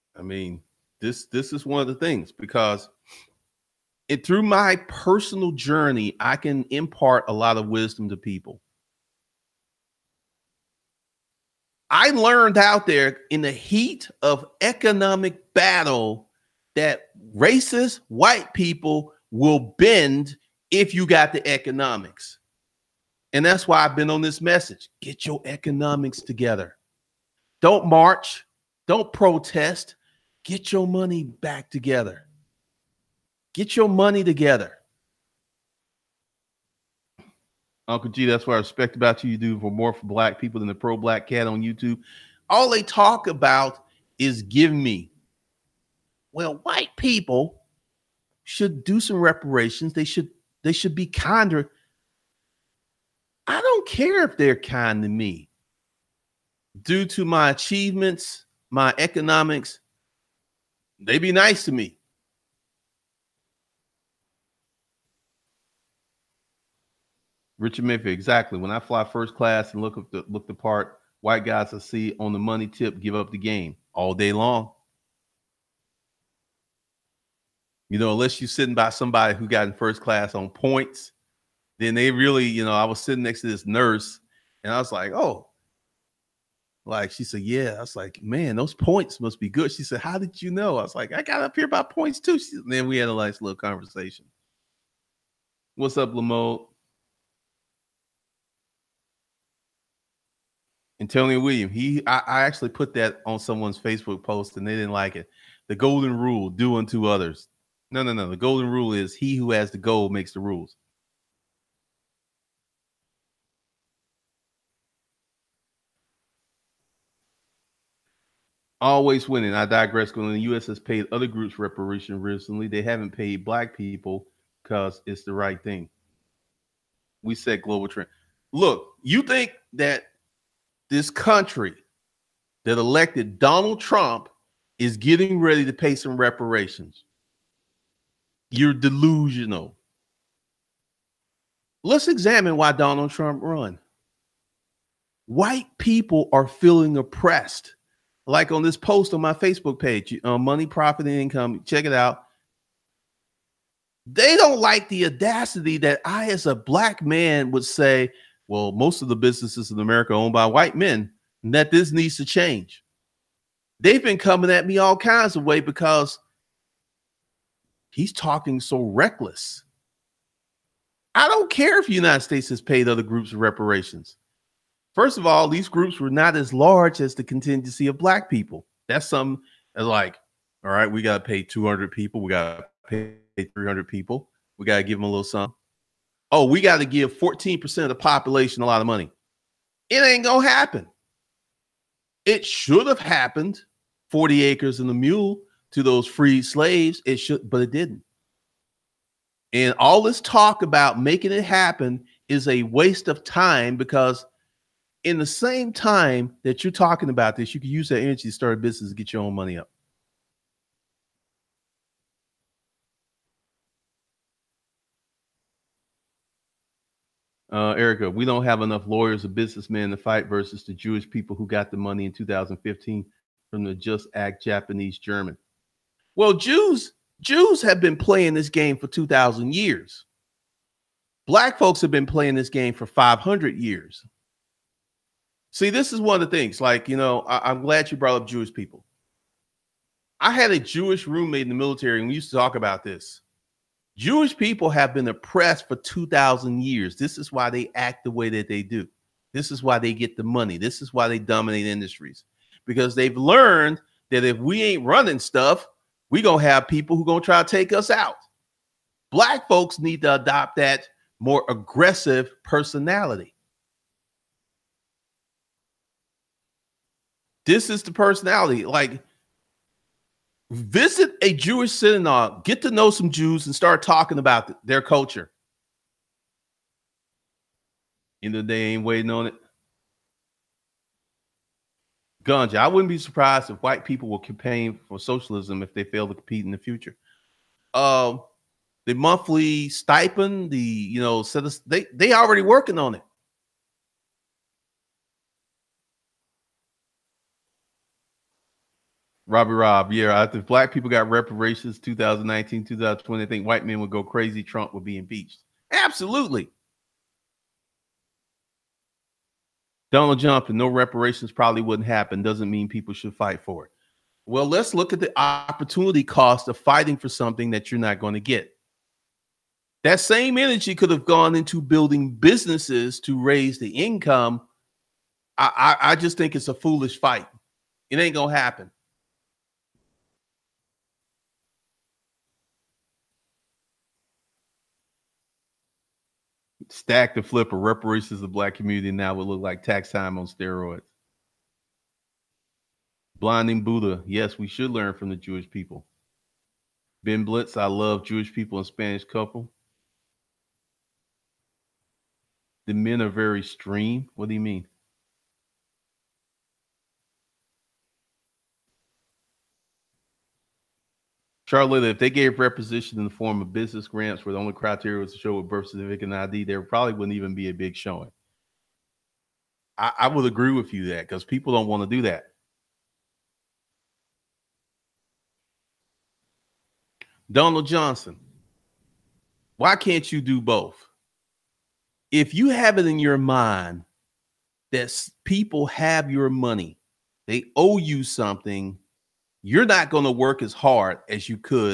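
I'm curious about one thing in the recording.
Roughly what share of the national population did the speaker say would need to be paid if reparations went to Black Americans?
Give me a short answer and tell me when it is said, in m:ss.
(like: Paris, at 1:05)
14%, at 3:07.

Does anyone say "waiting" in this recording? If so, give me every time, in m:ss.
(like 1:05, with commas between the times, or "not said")
4:38.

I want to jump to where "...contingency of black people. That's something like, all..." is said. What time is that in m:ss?
2:57.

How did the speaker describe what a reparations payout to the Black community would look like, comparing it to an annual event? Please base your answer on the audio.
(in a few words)
Tax time on steroids.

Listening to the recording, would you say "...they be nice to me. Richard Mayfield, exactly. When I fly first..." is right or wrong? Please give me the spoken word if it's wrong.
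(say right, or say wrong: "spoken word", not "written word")
right.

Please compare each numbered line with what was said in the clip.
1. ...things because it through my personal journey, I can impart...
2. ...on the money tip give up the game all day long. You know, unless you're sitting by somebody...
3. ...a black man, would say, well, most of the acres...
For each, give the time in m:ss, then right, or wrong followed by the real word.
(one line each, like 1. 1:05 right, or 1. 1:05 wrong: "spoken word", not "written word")
1. 0:01 right
2. 1:12 right
3. 2:36 wrong: "businesses", not "acres".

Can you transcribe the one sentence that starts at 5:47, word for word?
Ben Blitz, I love Jewish people and Spanish couple.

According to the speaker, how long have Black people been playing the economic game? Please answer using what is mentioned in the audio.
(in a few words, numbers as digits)
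500 years.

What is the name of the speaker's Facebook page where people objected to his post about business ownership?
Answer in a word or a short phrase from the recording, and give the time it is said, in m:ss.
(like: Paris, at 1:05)
Money, Profit, and Income, at 2:30.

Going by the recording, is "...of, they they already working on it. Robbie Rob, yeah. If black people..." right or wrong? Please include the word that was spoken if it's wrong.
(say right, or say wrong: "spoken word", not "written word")
right.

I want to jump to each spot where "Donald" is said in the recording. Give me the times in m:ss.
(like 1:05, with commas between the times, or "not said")
2:13, 2:22, 5:09, 6:17.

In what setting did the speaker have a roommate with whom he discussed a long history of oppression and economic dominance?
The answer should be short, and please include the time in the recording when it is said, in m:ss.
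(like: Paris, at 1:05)
The military, at 4:01.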